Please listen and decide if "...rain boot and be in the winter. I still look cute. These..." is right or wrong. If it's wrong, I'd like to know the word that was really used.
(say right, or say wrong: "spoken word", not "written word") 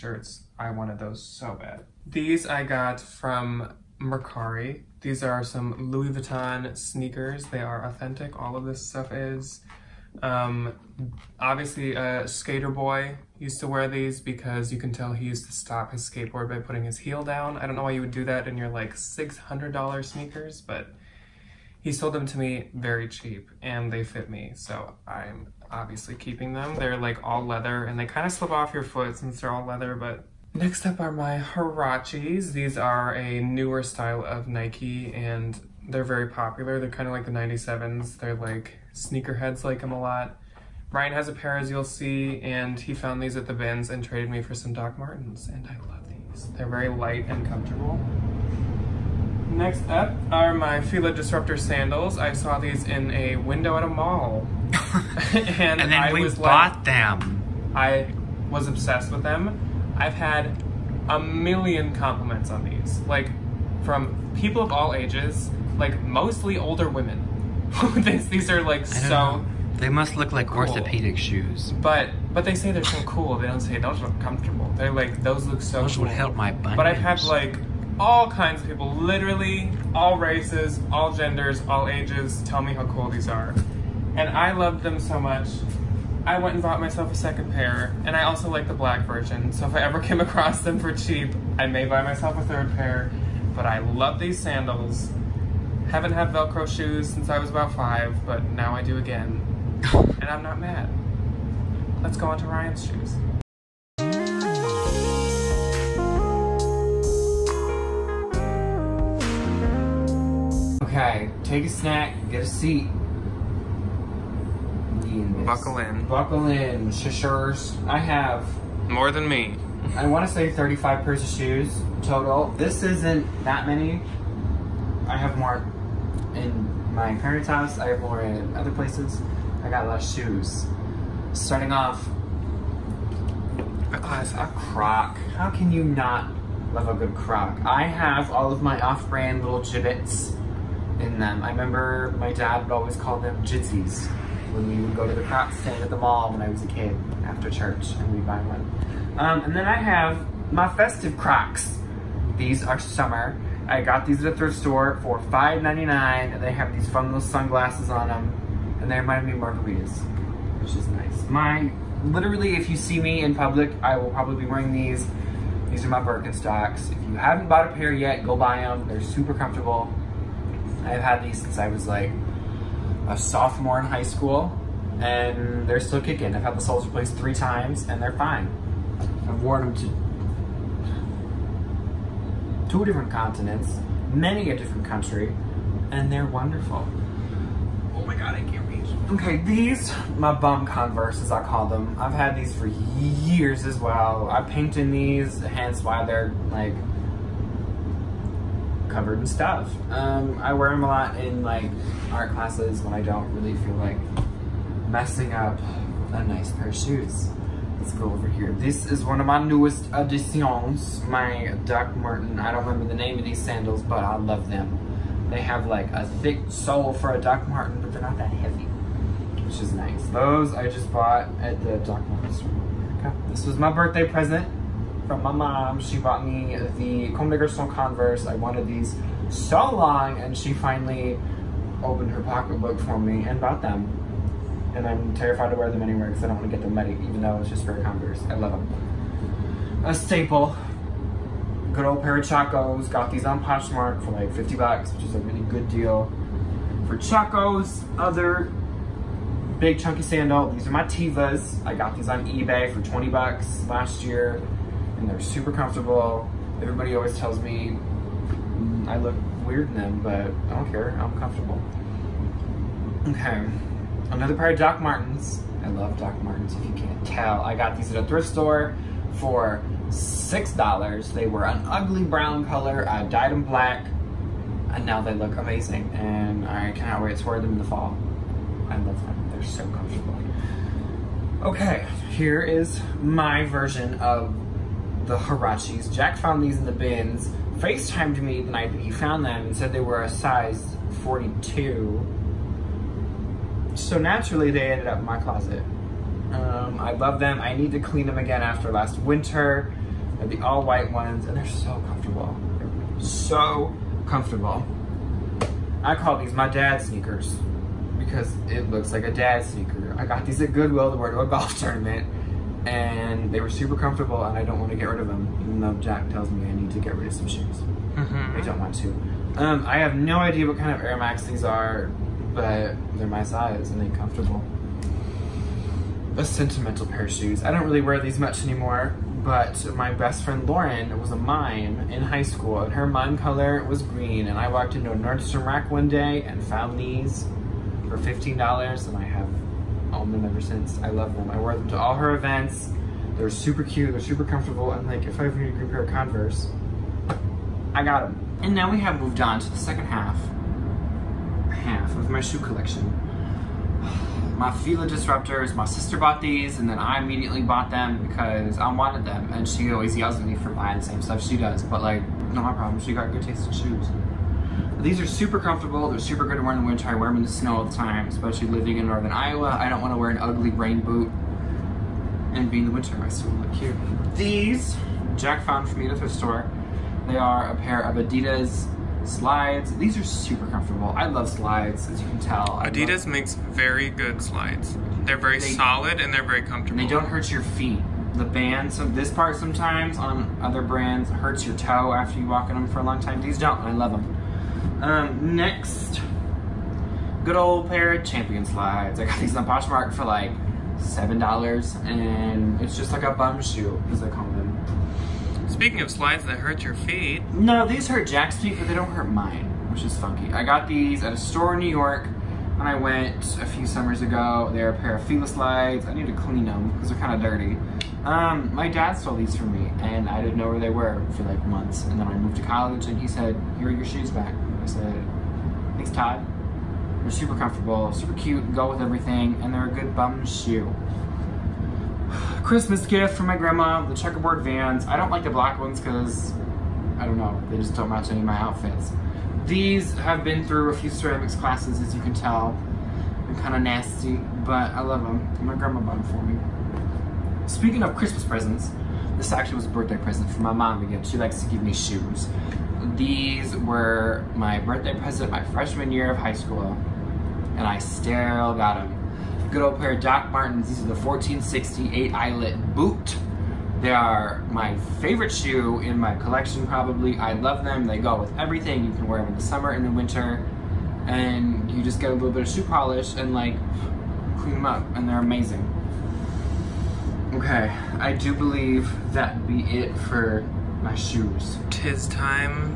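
right.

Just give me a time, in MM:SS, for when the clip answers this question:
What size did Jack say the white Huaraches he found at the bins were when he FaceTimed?
04:50.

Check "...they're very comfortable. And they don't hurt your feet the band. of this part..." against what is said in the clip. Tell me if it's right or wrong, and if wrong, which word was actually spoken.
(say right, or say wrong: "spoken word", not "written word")
right.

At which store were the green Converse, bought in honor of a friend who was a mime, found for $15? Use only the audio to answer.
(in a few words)
Nordstrom Rack.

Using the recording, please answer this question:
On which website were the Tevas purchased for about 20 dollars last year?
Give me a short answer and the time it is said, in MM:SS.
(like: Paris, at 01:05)
eBay, at 04:12.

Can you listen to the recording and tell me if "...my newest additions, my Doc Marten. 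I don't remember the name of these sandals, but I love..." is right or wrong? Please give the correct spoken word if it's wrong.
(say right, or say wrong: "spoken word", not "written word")
right.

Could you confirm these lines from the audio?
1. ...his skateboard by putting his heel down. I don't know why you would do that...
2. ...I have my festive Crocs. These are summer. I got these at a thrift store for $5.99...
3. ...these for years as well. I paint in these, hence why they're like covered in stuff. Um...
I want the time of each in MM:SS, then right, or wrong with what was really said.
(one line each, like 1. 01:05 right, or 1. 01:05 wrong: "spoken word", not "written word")
1. 00:15 right
2. 02:29 right
3. 03:12 right.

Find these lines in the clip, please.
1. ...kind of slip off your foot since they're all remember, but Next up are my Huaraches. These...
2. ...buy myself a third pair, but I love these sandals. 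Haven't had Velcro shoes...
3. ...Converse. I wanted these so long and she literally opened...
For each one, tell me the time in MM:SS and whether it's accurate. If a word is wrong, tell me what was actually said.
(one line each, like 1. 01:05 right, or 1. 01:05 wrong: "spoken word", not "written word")
1. 00:28 wrong: "leather", not "remember"
2. 01:31 right
3. 03:47 wrong: "finally", not "literally".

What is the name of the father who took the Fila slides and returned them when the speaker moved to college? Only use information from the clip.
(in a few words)
Todd.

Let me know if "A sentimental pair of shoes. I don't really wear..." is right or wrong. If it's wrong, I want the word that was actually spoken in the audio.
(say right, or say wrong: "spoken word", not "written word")
right.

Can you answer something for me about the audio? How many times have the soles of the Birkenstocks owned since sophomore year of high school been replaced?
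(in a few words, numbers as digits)
3.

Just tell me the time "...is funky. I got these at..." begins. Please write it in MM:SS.
06:49.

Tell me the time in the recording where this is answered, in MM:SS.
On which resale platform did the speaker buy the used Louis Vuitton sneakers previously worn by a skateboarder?
00:03.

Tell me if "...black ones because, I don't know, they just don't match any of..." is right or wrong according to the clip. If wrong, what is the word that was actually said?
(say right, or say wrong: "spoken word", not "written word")
right.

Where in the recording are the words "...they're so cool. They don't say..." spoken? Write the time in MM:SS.
01:12.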